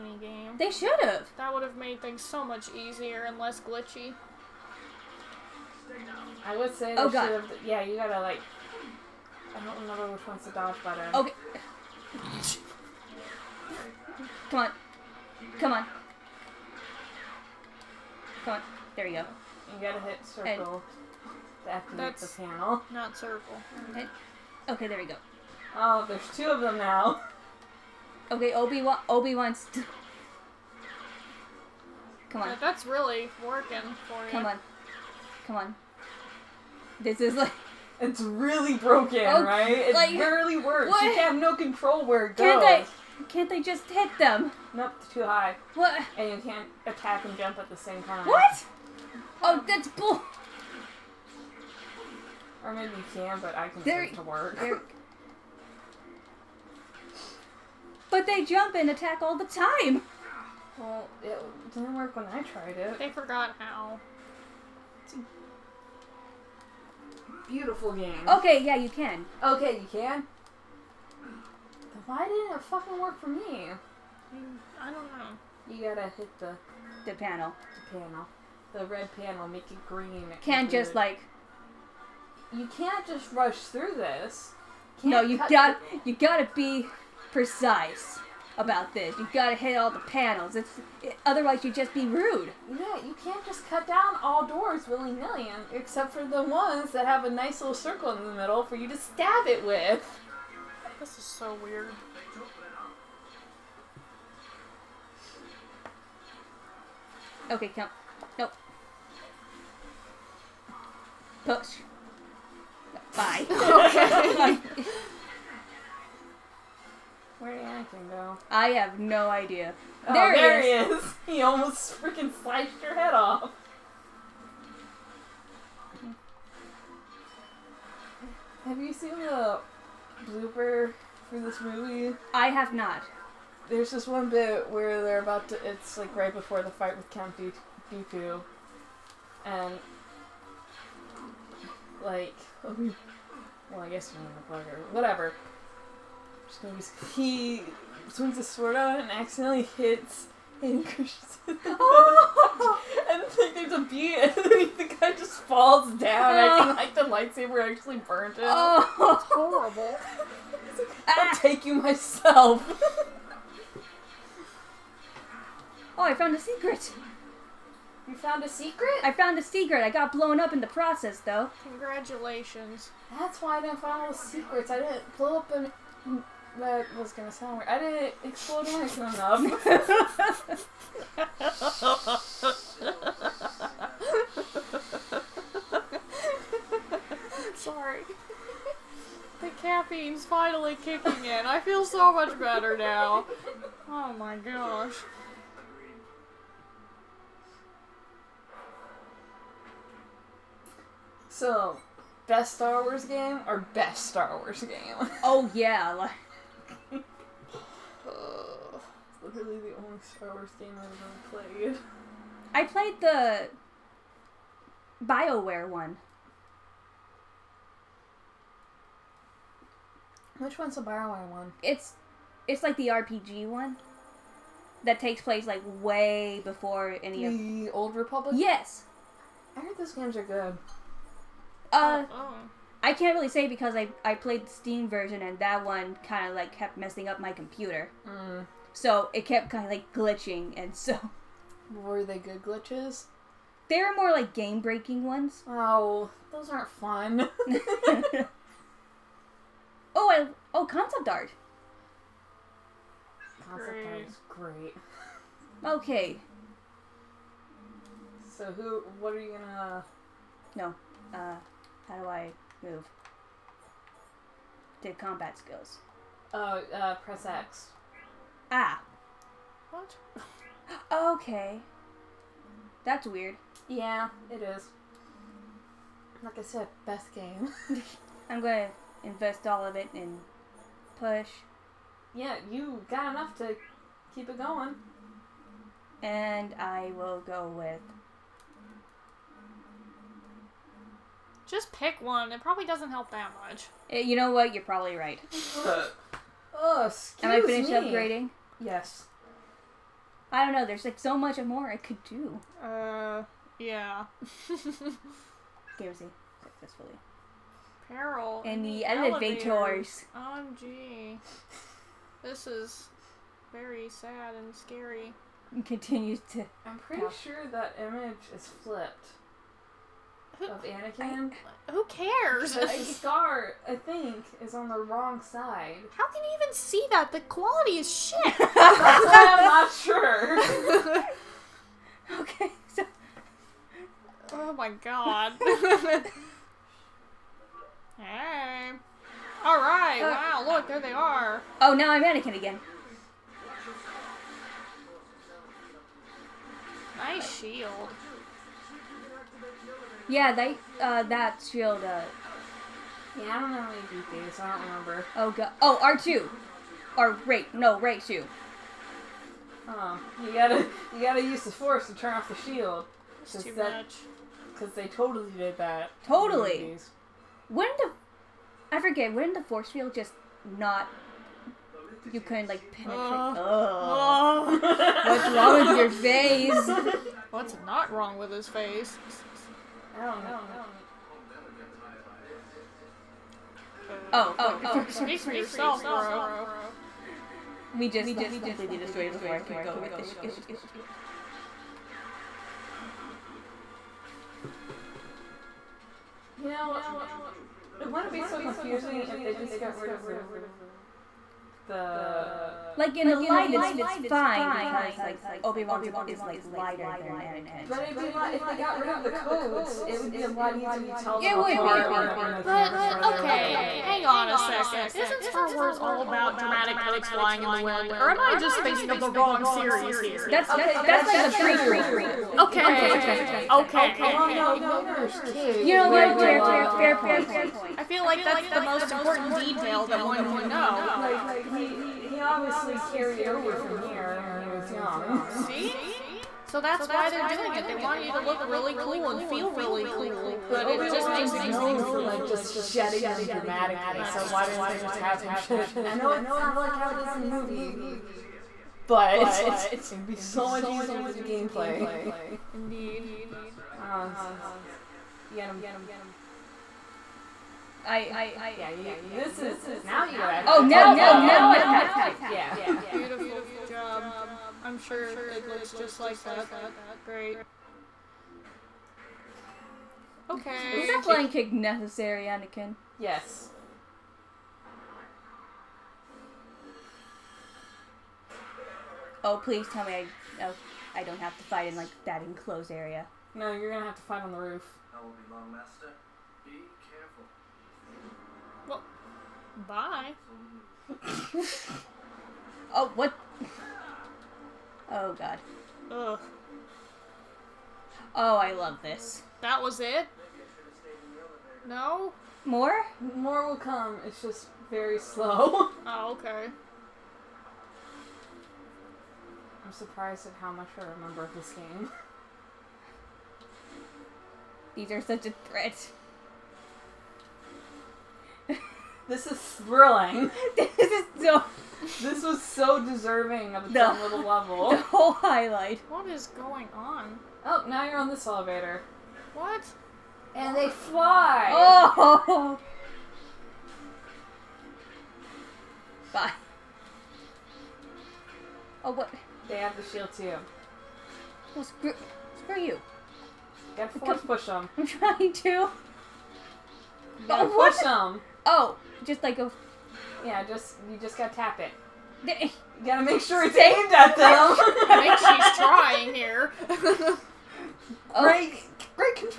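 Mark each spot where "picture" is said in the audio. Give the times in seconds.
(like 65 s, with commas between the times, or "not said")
not said.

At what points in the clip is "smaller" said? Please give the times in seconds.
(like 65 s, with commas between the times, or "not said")
not said.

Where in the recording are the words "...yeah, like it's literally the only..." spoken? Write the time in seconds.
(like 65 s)
205 s.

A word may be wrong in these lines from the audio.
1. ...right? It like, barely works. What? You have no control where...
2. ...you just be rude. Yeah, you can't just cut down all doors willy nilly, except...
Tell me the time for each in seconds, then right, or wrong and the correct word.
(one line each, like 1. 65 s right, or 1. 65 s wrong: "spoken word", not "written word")
1. 39 s right
2. 91 s right.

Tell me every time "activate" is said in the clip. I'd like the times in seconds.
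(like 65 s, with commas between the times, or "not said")
21 s.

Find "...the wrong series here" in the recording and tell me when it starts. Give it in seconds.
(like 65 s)
418 s.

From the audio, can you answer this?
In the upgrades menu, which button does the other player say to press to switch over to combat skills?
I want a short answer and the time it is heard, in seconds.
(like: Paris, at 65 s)
X, at 266 s.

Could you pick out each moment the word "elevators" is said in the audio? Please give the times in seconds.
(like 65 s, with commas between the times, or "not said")
308 s, 528 s.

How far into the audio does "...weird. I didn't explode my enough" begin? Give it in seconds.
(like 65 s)
177 s.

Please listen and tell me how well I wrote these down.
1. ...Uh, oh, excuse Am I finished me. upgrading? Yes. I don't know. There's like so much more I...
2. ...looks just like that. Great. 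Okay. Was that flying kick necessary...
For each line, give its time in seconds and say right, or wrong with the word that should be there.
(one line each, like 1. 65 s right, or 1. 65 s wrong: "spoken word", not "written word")
1. 295 s right
2. 465 s right.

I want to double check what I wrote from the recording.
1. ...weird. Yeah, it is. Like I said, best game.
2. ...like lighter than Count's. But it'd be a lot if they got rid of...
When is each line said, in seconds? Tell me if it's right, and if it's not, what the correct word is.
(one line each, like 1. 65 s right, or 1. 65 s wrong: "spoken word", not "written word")
1. 273 s right
2. 406 s wrong: "Anakin", not "Count".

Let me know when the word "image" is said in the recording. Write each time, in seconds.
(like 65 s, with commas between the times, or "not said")
317 s.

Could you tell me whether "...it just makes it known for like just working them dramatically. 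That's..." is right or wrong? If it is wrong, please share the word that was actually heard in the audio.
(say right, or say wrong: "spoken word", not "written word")
wrong: "shedding", not "working".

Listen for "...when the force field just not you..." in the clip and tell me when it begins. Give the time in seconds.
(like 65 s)
369 s.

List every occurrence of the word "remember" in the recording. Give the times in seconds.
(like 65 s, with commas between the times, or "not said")
9 s, 354 s, 510 s.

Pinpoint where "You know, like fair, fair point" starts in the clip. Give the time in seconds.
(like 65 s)
425 s.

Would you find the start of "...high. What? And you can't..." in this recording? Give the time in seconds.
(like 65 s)
45 s.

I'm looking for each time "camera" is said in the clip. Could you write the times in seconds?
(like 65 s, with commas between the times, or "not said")
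412 s.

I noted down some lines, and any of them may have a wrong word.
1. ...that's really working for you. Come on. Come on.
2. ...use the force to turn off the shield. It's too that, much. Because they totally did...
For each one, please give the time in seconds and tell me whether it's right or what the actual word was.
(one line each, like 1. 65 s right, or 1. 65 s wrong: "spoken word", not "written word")
1. 32 s right
2. 361 s right.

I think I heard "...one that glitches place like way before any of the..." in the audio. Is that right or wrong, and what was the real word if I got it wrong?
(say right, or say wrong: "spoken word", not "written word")
wrong: "takes", not "glitches".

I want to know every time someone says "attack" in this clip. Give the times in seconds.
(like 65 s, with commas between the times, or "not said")
46 s, 58 s.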